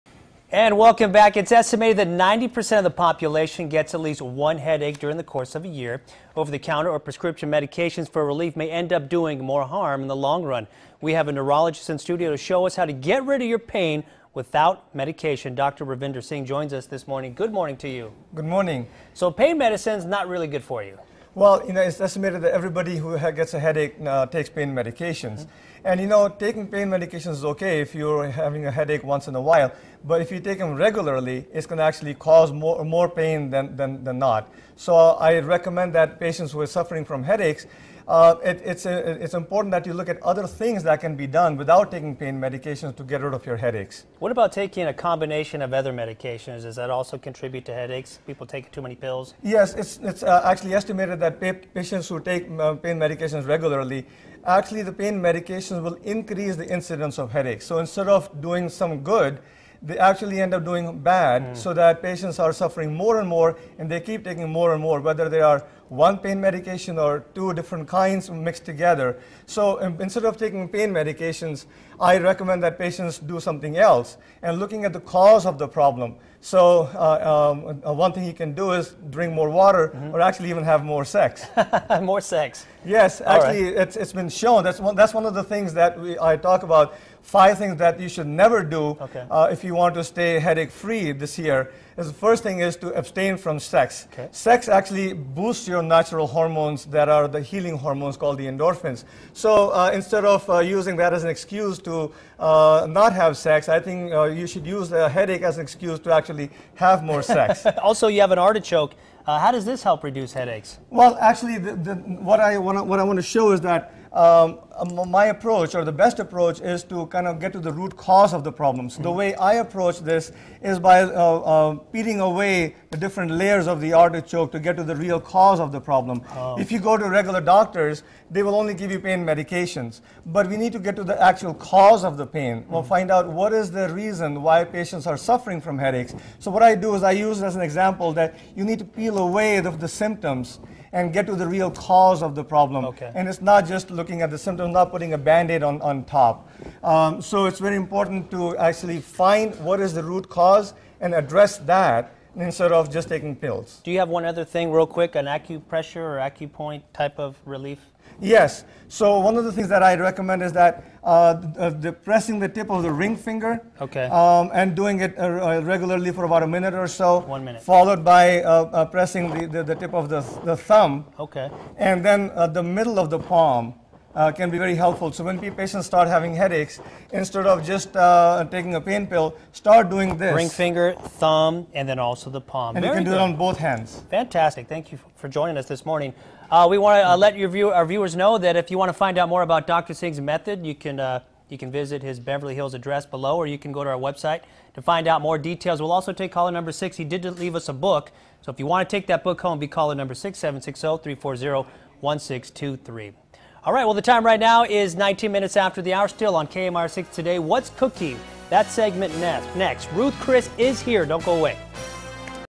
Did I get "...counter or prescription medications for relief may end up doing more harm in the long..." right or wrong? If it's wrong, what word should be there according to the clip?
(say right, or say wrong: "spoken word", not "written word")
right.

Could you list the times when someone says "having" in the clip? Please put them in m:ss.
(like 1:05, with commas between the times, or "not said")
0:28, 2:56.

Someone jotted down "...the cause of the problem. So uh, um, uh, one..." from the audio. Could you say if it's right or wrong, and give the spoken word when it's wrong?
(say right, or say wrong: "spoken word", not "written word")
right.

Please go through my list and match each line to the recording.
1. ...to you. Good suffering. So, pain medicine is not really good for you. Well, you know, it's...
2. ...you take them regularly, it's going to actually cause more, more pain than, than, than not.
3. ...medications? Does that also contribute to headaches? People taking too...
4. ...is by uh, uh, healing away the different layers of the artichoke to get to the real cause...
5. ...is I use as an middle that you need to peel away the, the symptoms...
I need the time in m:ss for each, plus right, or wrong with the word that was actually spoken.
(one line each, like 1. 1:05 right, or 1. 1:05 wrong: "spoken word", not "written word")
1. 0:17 wrong: "morning", not "suffering"
2. 0:30 right
3. 0:45 right
4. 2:00 wrong: "peeling", not "healing"
5. 2:16 wrong: "example", not "middle".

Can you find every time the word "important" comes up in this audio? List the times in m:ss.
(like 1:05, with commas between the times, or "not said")
0:39, 2:27.